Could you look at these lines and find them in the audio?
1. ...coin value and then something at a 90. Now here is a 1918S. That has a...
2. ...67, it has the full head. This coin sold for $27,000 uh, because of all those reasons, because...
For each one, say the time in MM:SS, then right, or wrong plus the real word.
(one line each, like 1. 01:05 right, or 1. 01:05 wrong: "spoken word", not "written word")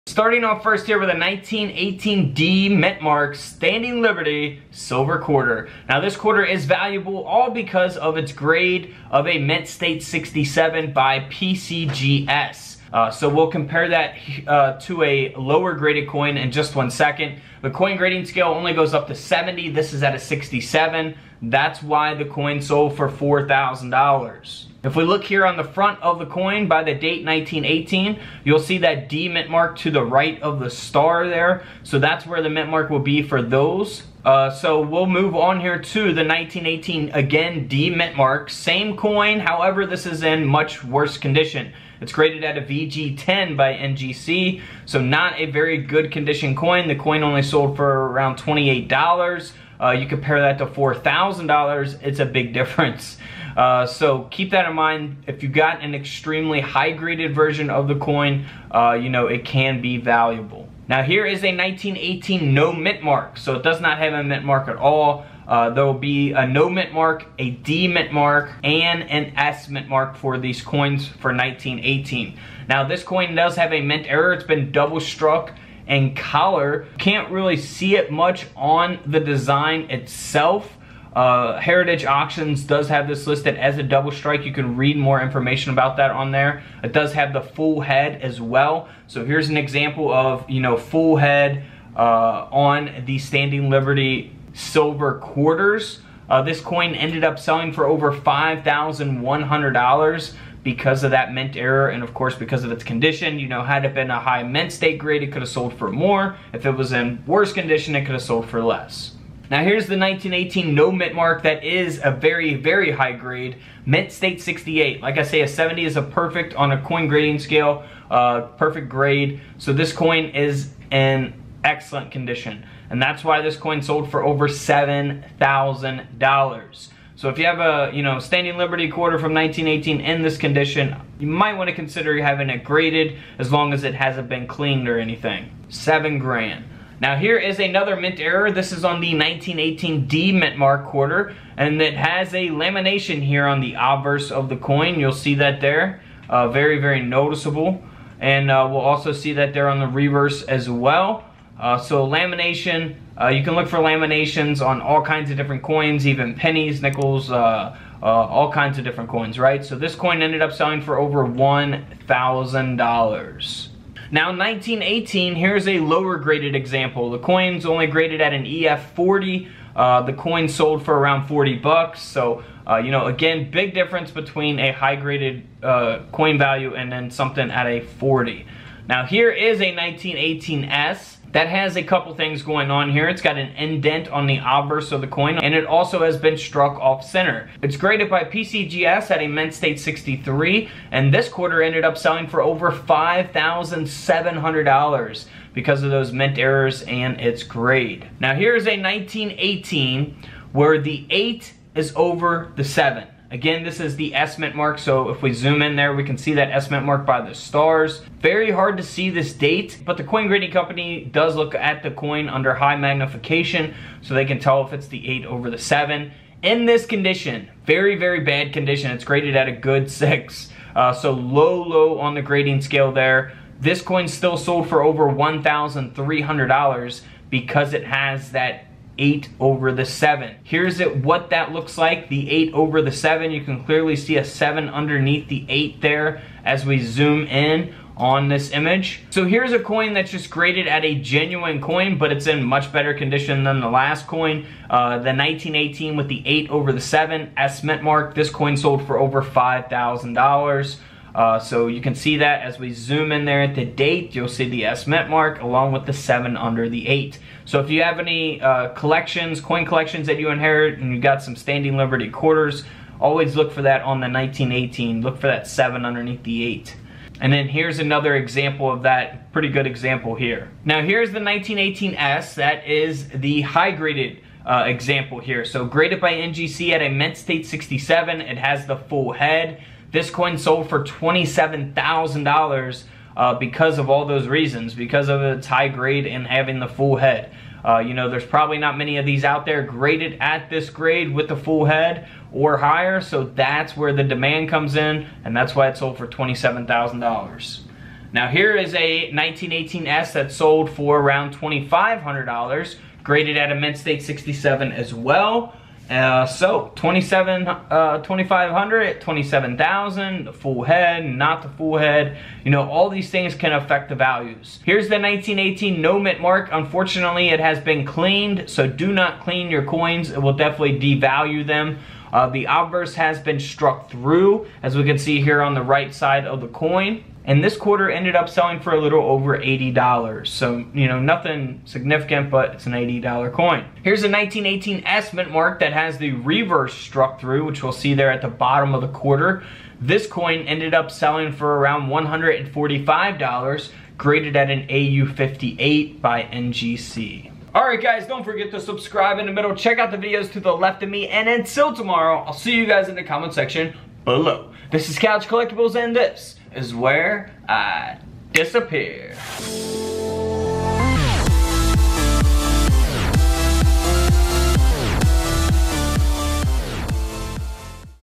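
1. 02:56 wrong: "40", not "90"
2. 04:37 right.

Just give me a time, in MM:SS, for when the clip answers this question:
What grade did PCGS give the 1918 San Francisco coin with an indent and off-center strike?
03:09.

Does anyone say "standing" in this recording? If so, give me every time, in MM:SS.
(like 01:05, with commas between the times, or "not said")
00:03, 01:33, 02:08, 04:21.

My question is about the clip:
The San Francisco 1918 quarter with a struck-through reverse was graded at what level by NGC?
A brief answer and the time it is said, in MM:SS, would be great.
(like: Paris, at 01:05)
AU58, at 05:44.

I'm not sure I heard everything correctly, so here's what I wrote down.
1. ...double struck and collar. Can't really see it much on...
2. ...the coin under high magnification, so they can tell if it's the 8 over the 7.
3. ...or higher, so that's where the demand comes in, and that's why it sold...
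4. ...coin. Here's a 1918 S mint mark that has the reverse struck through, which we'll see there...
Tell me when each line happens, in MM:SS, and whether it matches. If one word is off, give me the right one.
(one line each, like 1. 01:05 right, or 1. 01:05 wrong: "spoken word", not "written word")
1. 01:14 right
2. 03:31 right
3. 04:52 right
4. 05:33 right.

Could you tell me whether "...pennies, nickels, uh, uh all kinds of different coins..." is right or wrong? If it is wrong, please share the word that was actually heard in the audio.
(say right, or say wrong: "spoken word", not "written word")
right.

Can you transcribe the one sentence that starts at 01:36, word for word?
Uh, this coin ended up selling for over $5,100 because of that mint error and of course because of its condition.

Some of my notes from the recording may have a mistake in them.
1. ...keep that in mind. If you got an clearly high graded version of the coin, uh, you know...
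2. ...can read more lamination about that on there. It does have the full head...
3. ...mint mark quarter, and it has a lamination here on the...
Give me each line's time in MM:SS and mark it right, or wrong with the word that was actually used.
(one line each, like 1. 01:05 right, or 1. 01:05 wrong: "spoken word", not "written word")
1. 00:54 wrong: "extremely", not "clearly"
2. 01:24 wrong: "information", not "lamination"
3. 02:20 right.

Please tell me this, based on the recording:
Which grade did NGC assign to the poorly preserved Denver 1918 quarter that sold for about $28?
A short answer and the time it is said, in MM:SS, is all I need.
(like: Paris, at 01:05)
VG10, at 00:42.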